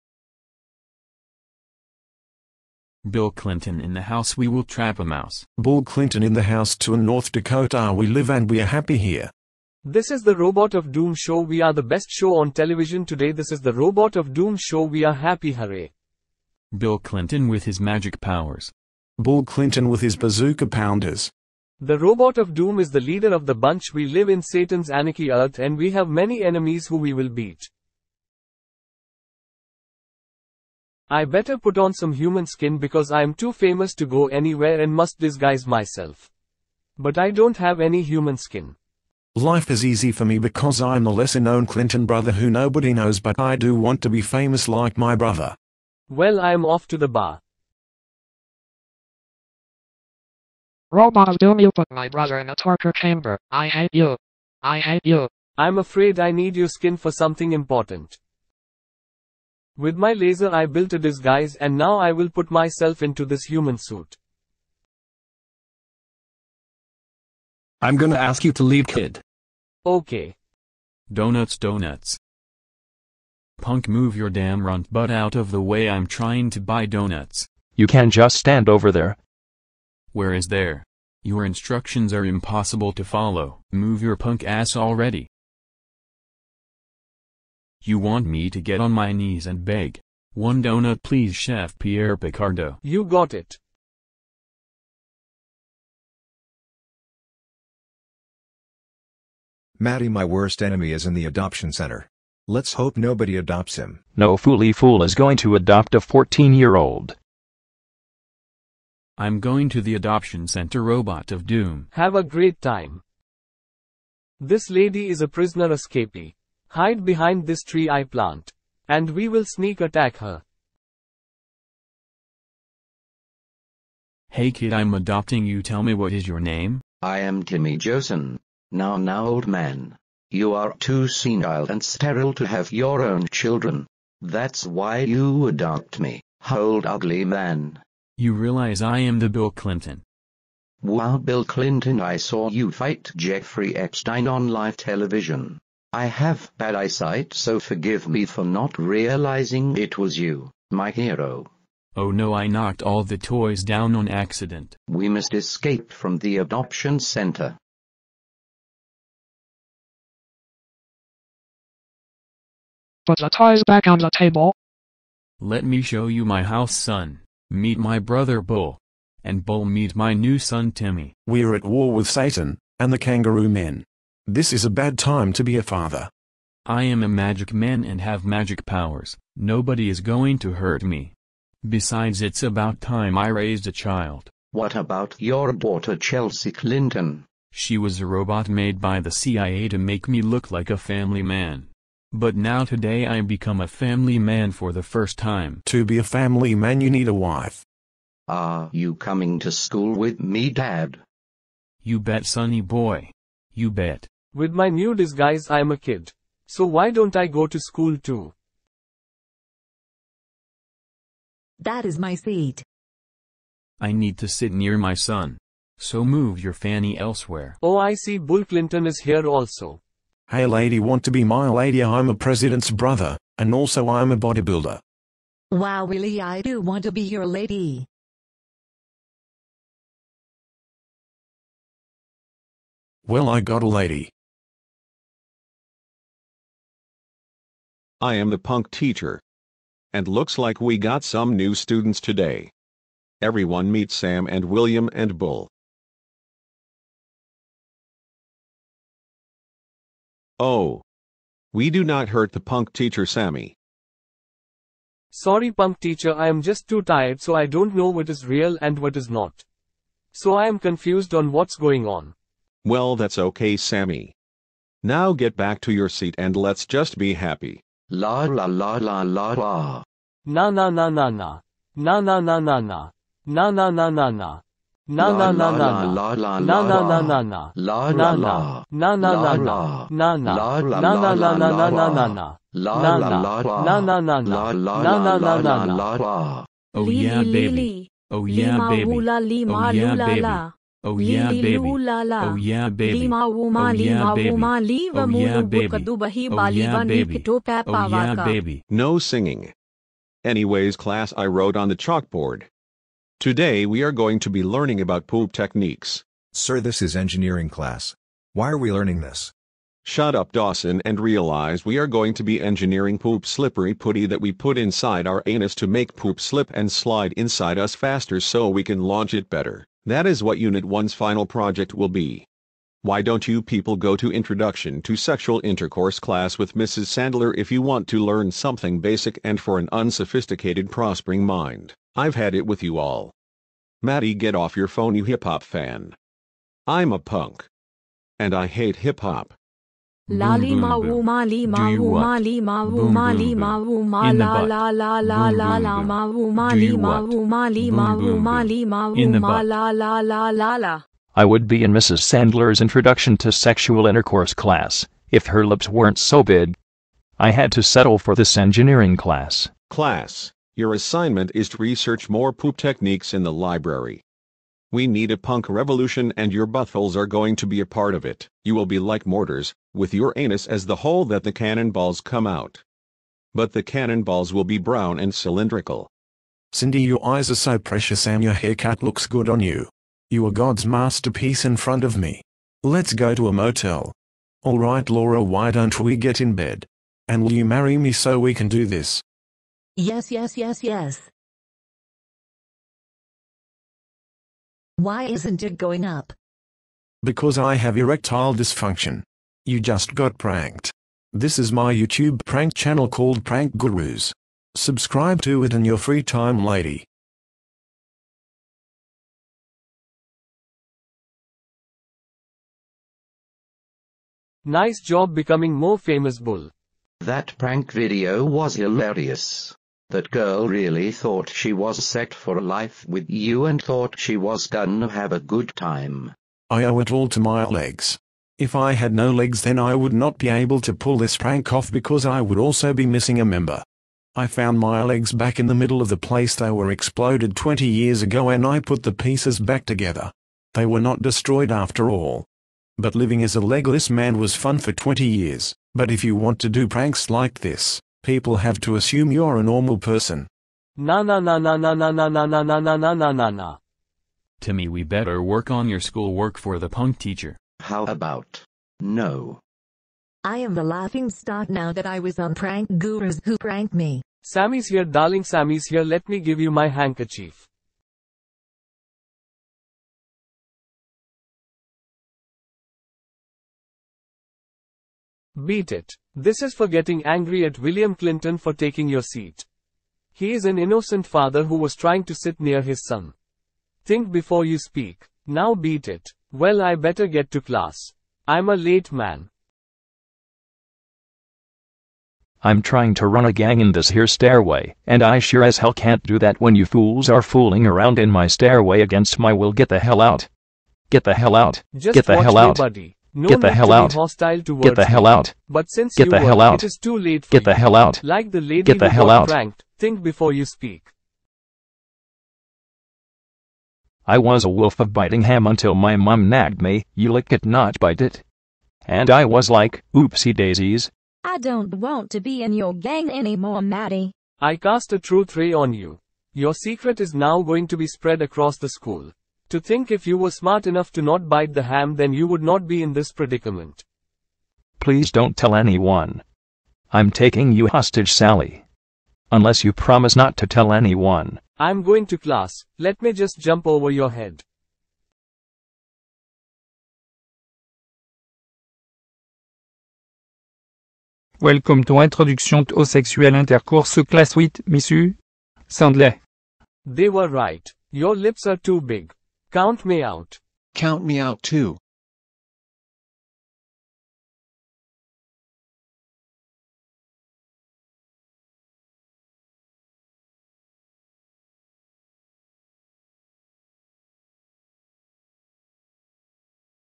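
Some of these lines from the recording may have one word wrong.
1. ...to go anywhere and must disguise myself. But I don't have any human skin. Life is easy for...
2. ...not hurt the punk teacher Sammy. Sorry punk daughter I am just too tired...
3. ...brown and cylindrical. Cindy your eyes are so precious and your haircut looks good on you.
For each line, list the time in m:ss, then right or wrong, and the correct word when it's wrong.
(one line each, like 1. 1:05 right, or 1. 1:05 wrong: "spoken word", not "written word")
1. 0:33 right
2. 4:11 wrong: "teacher", not "daughter"
3. 6:14 right.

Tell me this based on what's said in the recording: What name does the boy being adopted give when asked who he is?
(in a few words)
Timmy Josen.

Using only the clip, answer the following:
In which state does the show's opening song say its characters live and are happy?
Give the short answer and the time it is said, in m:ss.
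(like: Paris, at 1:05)
North Dakota, at 0:07.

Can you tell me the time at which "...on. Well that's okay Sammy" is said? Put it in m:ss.
4:21.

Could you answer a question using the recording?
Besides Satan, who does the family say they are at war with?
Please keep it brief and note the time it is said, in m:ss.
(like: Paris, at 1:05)
the kangaroo men, at 2:52.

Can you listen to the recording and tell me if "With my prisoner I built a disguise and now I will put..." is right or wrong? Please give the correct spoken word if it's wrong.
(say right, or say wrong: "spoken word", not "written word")
wrong: "laser", not "prisoner".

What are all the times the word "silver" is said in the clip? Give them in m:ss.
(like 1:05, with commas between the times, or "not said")
not said.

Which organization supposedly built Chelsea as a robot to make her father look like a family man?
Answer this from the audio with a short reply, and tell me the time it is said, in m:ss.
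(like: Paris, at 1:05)
CIA, at 3:09.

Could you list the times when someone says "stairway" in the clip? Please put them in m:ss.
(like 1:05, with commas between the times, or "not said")
8:14, 8:18.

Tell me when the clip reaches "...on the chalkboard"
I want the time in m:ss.
5:01.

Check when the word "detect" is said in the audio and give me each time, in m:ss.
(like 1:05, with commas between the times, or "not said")
not said.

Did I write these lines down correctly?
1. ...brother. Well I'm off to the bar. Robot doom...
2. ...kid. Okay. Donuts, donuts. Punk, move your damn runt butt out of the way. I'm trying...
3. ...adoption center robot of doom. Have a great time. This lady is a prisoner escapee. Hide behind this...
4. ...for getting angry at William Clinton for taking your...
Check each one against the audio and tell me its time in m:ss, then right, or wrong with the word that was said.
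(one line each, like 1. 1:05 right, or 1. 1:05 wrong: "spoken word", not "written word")
1. 0:45 right
2. 1:08 right
3. 1:49 right
4. 7:56 right.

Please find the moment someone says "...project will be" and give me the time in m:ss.
5:21.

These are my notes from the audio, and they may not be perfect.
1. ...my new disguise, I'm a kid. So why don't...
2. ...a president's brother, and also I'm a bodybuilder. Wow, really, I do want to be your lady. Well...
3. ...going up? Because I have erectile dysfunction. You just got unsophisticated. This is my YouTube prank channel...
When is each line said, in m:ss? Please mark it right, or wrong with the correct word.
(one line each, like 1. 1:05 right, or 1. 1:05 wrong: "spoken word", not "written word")
1. 3:24 right
2. 3:42 right
3. 6:35 wrong: "pranked", not "unsophisticated".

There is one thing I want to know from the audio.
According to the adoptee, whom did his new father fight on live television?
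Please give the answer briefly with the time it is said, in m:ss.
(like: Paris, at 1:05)
Jeffrey Epstein, at 2:23.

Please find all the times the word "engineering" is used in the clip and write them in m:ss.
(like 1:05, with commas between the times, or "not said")
5:06, 5:12, 5:58.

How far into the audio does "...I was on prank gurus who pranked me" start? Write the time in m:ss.
7:41.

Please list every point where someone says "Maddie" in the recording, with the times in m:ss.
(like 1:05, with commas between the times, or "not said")
1:39, 5:33, 8:43.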